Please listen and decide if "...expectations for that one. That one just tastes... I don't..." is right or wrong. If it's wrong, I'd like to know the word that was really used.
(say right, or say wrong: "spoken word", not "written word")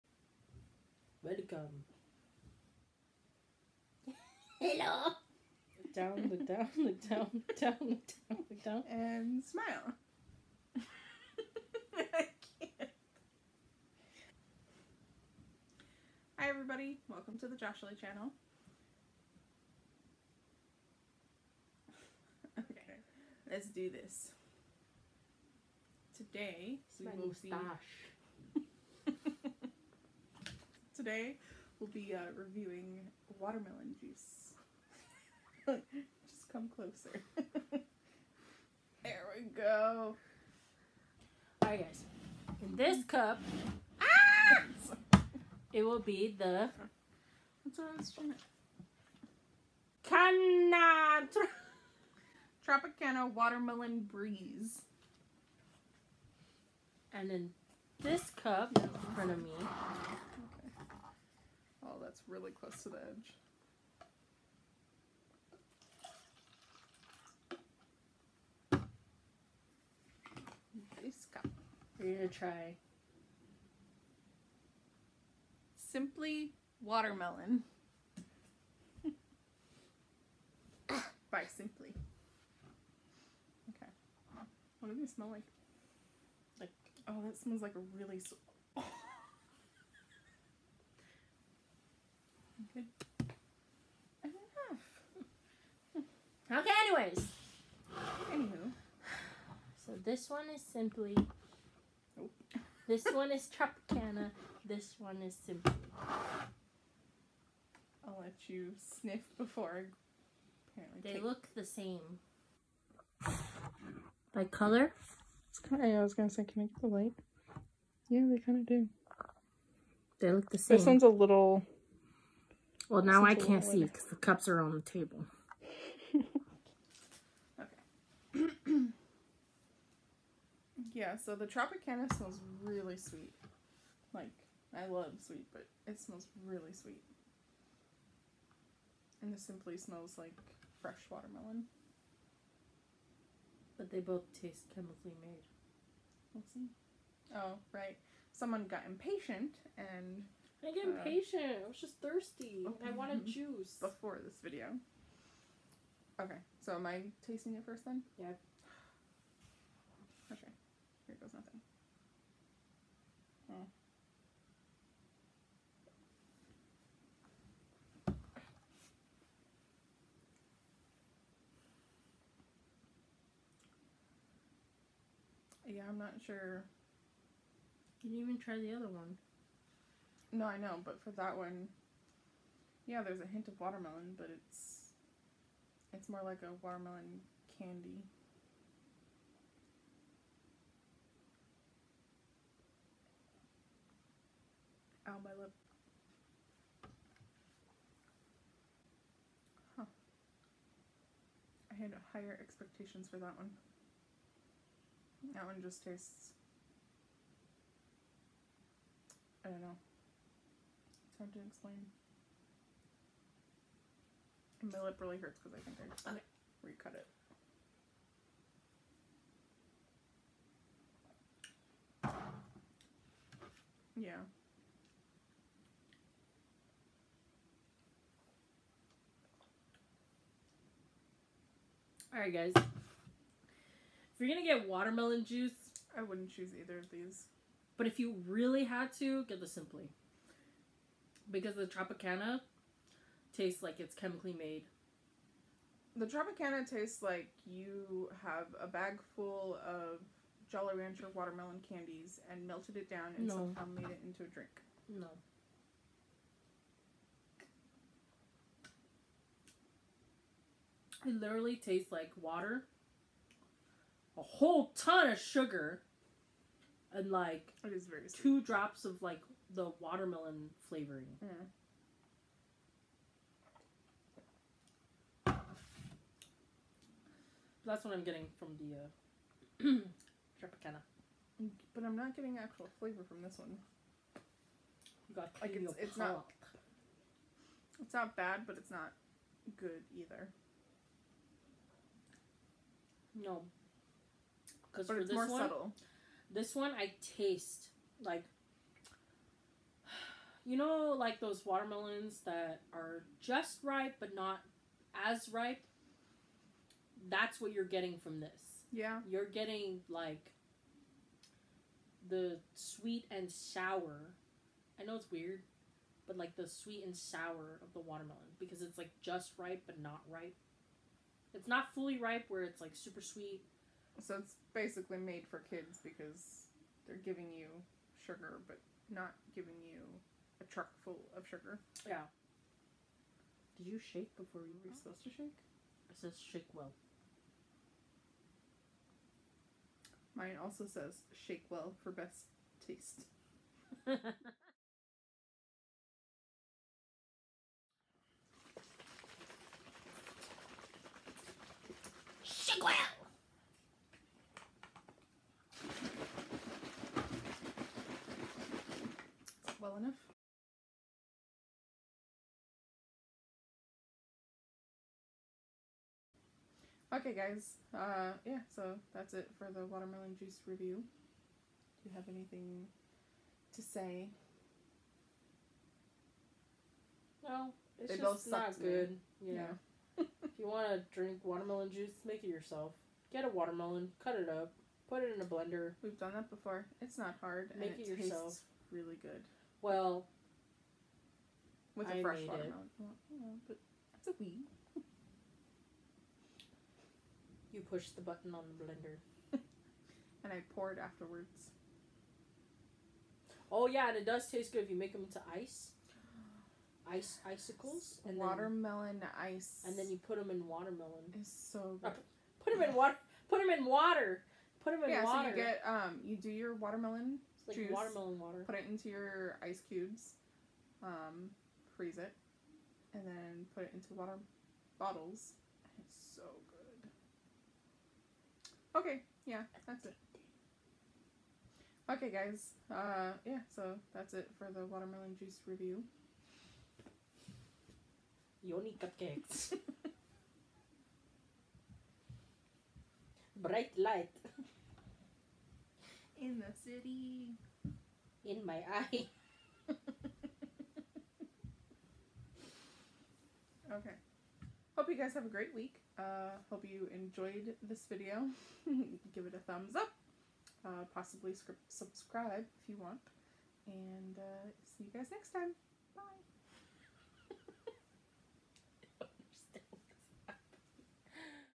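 right.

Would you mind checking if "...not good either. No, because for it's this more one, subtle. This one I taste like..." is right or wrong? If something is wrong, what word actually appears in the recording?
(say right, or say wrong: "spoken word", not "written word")
right.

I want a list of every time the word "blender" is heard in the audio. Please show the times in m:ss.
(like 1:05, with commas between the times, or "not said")
6:25, 6:38.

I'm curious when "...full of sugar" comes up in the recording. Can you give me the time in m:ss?
5:30.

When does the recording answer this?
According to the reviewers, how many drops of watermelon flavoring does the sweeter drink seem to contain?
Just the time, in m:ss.
4:28.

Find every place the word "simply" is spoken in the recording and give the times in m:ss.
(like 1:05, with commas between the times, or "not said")
1:15, 1:21, 1:40, 1:45, 2:19, 3:59.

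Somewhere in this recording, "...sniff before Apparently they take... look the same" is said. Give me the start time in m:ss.
1:48.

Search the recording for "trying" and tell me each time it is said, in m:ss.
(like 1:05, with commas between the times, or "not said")
0:50.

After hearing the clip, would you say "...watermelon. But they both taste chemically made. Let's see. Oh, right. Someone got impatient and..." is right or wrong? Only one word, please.
right.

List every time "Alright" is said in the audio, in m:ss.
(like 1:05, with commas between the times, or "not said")
0:41, 3:52.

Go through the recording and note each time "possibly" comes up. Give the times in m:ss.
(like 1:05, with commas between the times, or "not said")
7:40.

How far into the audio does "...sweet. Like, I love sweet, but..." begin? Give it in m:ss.
2:12.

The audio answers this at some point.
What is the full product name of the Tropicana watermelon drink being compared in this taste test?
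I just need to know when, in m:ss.
0:52.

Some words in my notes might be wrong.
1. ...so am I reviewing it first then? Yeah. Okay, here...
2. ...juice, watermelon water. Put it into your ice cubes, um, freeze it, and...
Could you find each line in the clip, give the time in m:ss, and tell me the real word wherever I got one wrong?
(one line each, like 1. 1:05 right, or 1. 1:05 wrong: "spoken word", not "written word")
1. 2:36 wrong: "tasting", not "reviewing"
2. 6:57 right.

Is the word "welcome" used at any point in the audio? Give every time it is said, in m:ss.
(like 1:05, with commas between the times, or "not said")
0:01, 0:17.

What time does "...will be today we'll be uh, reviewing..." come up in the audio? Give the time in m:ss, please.
0:27.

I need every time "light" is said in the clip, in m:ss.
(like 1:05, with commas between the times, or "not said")
1:56, 7:23.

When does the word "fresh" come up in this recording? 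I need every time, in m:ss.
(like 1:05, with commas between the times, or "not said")
2:20, 6:32.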